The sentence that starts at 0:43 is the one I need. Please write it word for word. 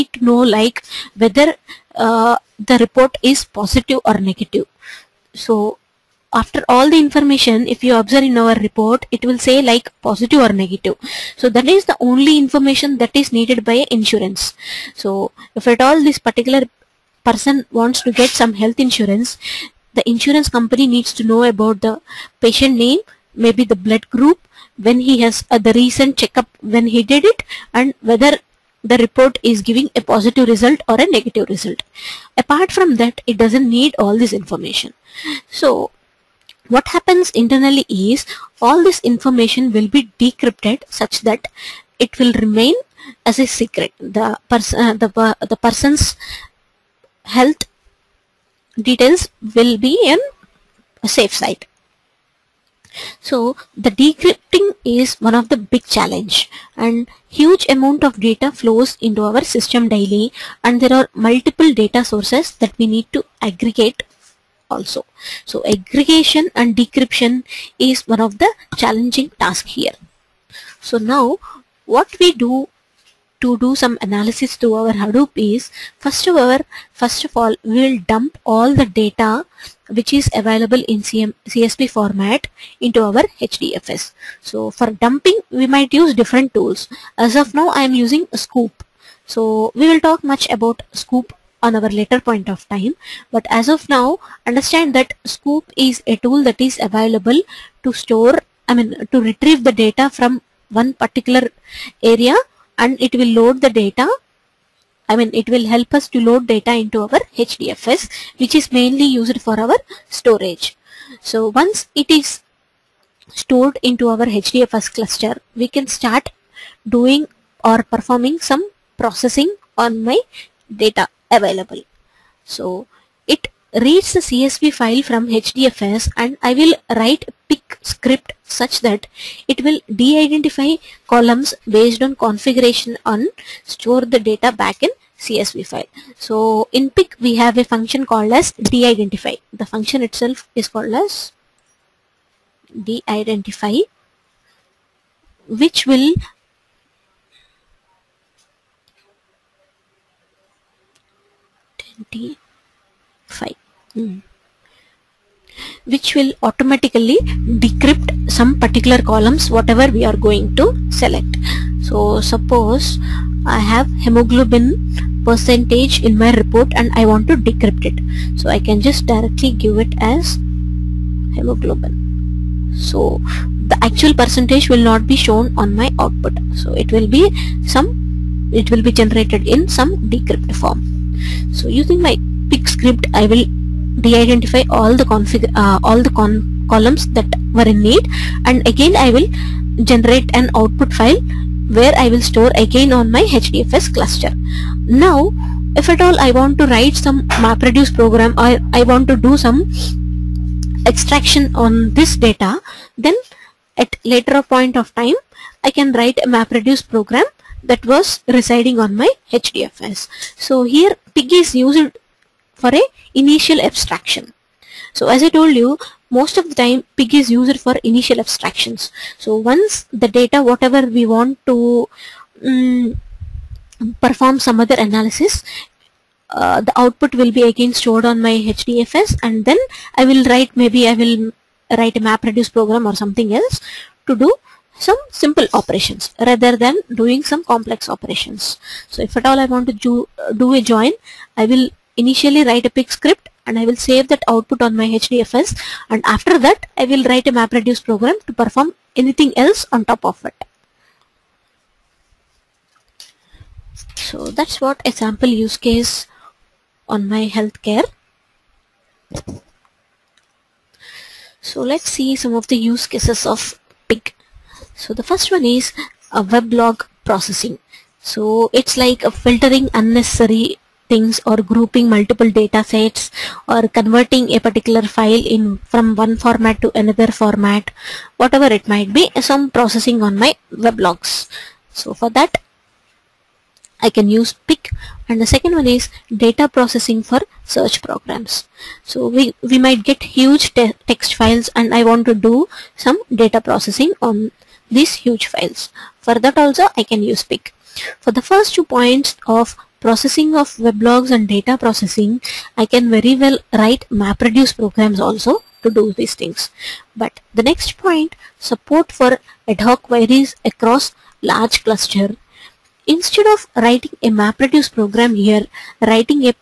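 The, pers uh, the, uh, the person's health details will be in a safe side.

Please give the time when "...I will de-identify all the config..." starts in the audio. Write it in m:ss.
3:03.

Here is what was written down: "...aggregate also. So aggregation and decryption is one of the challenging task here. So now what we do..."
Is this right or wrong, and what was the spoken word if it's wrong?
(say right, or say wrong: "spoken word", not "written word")
right.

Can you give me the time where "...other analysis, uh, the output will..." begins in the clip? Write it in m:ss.
3:44.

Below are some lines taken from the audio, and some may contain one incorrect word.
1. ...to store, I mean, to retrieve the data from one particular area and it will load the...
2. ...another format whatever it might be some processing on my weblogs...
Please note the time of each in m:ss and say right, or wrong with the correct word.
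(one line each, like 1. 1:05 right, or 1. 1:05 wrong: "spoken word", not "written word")
1. 1:37 right
2. 4:36 right.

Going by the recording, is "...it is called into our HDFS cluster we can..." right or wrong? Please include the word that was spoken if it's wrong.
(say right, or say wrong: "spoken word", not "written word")
wrong: "stored", not "called".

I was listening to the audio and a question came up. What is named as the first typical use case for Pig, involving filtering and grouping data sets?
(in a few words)
weblog processing.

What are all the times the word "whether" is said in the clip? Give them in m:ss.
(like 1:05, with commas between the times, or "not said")
0:01, 0:28.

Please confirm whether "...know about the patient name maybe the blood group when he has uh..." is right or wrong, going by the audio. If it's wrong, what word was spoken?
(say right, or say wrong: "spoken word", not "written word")
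right.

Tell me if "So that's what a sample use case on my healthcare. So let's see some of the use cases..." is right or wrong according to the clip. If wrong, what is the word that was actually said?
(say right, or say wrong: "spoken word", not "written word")
right.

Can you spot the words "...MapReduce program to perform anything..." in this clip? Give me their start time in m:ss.
4:07.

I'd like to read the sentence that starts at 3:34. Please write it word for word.
So as I told you, most of the time PIG is used for initial abstractions.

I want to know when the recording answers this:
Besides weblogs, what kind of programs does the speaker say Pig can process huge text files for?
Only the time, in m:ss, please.
4:46.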